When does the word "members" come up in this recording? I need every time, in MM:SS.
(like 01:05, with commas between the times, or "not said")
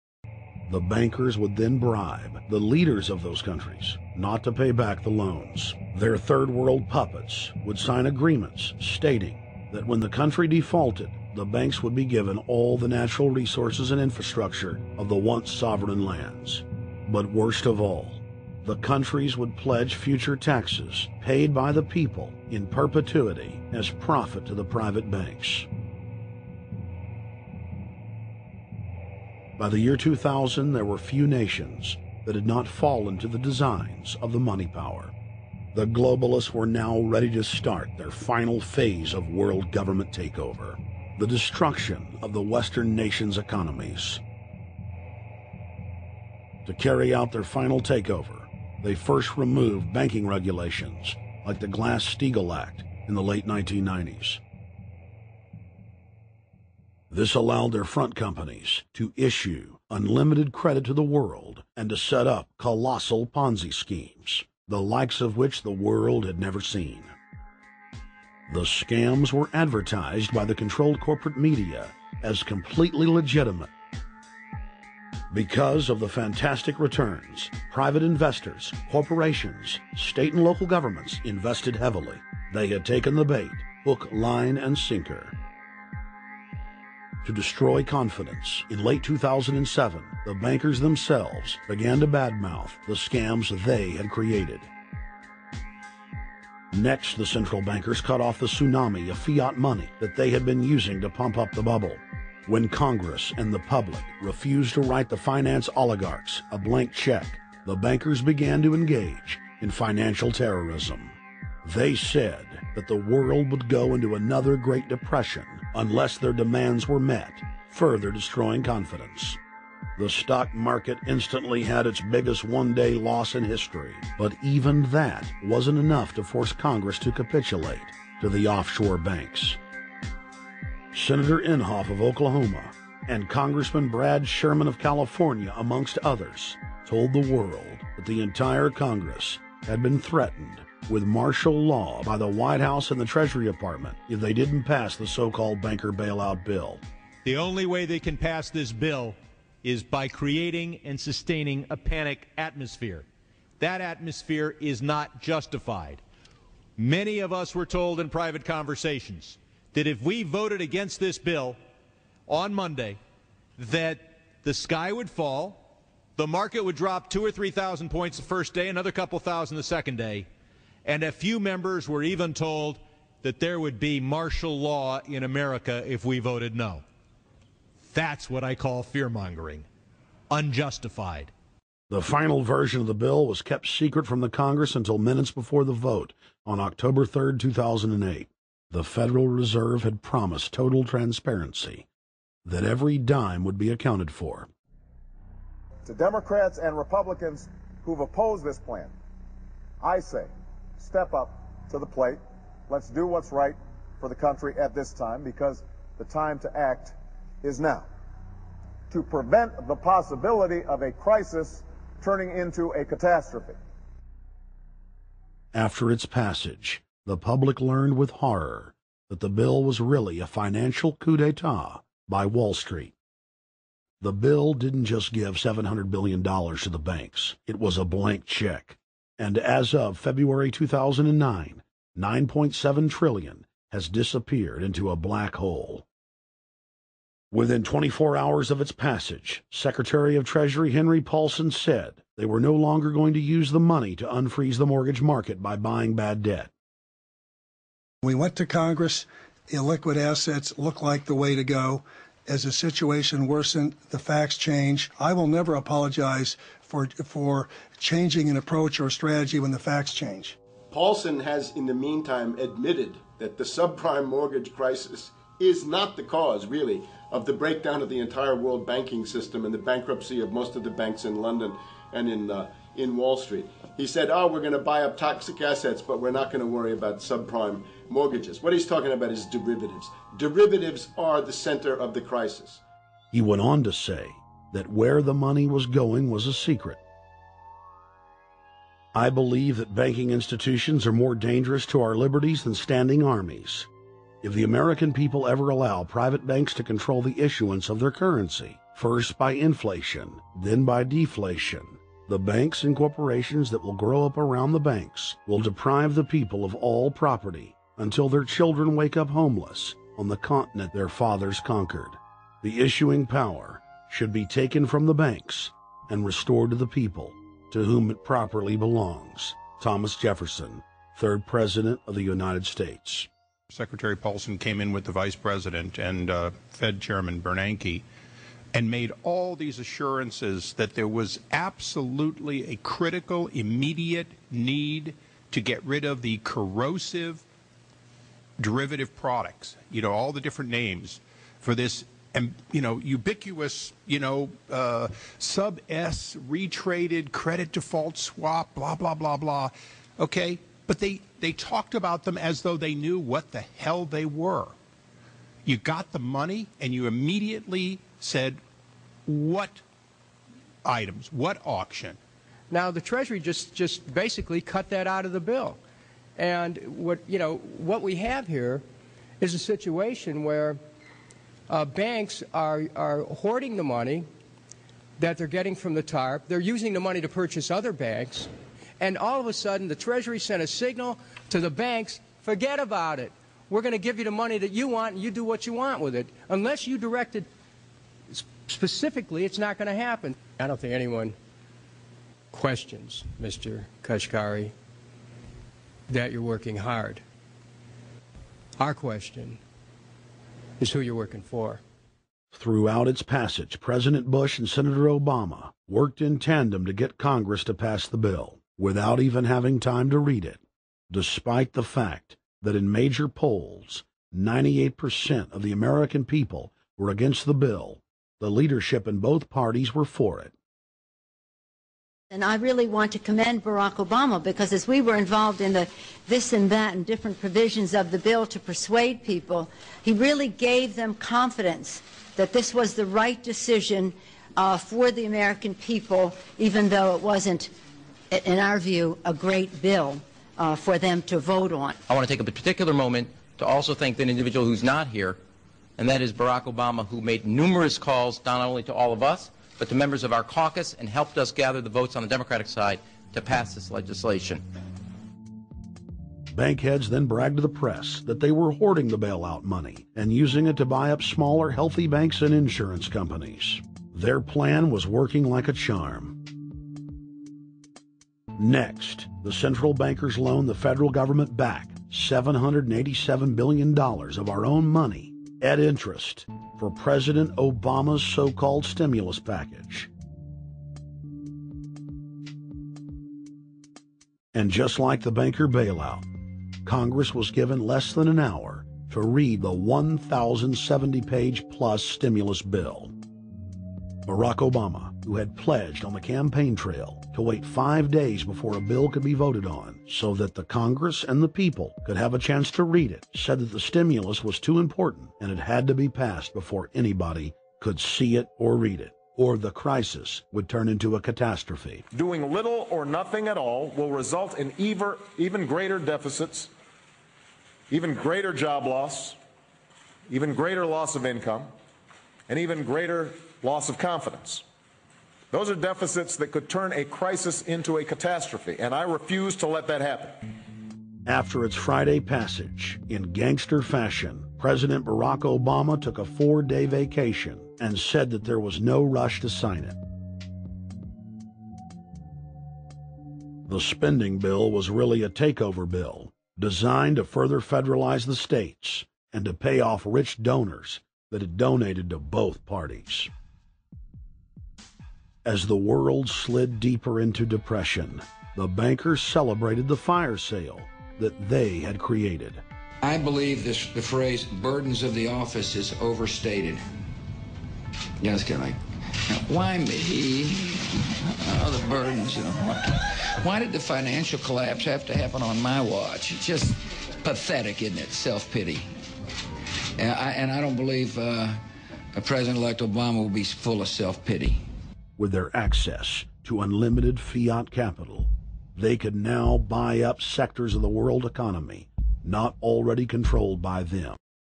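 02:51, 07:29.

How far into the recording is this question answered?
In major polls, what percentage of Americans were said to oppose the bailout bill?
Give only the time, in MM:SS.
06:54.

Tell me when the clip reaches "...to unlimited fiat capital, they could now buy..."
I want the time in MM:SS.
09:46.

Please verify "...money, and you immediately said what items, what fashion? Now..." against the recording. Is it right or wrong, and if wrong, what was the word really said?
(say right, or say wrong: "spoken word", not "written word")
wrong: "auction", not "fashion".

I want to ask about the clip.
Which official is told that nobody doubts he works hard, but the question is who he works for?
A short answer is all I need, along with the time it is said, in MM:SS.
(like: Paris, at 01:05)
Kashkari, at 06:33.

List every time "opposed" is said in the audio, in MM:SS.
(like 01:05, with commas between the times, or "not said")
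03:17.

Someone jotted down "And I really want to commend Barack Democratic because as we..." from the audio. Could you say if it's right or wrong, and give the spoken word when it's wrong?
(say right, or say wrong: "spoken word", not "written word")
wrong: "Obama", not "Democratic".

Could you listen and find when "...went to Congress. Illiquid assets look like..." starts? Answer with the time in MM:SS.
04:08.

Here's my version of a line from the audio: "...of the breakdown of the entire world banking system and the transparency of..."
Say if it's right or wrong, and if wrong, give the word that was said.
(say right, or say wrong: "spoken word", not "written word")
wrong: "bankruptcy", not "transparency".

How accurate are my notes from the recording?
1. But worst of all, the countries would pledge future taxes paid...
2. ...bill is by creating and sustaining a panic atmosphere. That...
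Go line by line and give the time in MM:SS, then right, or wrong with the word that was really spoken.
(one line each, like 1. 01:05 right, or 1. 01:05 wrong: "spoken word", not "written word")
1. 00:17 right
2. 02:28 right.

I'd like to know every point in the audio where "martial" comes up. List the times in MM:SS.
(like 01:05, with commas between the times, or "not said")
02:21, 02:53.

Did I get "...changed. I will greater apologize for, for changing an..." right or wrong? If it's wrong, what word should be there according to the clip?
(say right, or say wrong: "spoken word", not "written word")
wrong: "never", not "greater".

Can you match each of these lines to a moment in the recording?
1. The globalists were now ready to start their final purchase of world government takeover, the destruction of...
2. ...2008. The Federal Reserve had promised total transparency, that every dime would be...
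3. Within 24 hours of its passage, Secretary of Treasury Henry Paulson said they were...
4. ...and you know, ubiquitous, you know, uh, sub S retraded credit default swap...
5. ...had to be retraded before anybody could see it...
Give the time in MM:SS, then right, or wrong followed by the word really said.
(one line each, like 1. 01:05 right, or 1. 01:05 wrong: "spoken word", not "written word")
1. 00:35 wrong: "phase", not "purchase"
2. 03:07 right
3. 03:57 right
4. 05:42 right
5. 08:25 wrong: "passed", not "retraded".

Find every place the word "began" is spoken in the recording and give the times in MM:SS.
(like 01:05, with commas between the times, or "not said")
01:31, 01:48.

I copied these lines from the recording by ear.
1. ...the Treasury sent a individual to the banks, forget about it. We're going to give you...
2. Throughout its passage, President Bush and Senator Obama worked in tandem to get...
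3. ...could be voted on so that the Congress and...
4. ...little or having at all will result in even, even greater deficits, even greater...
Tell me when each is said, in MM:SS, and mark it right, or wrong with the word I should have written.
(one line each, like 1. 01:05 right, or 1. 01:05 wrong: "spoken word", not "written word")
1. 06:19 wrong: "signal", not "individual"
2. 06:42 right
3. 08:18 right
4. 08:32 wrong: "nothing", not "having".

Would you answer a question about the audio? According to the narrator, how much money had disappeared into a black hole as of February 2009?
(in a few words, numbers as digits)
9.7 trillion.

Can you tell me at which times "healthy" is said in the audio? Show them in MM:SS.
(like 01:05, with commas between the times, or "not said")
07:41.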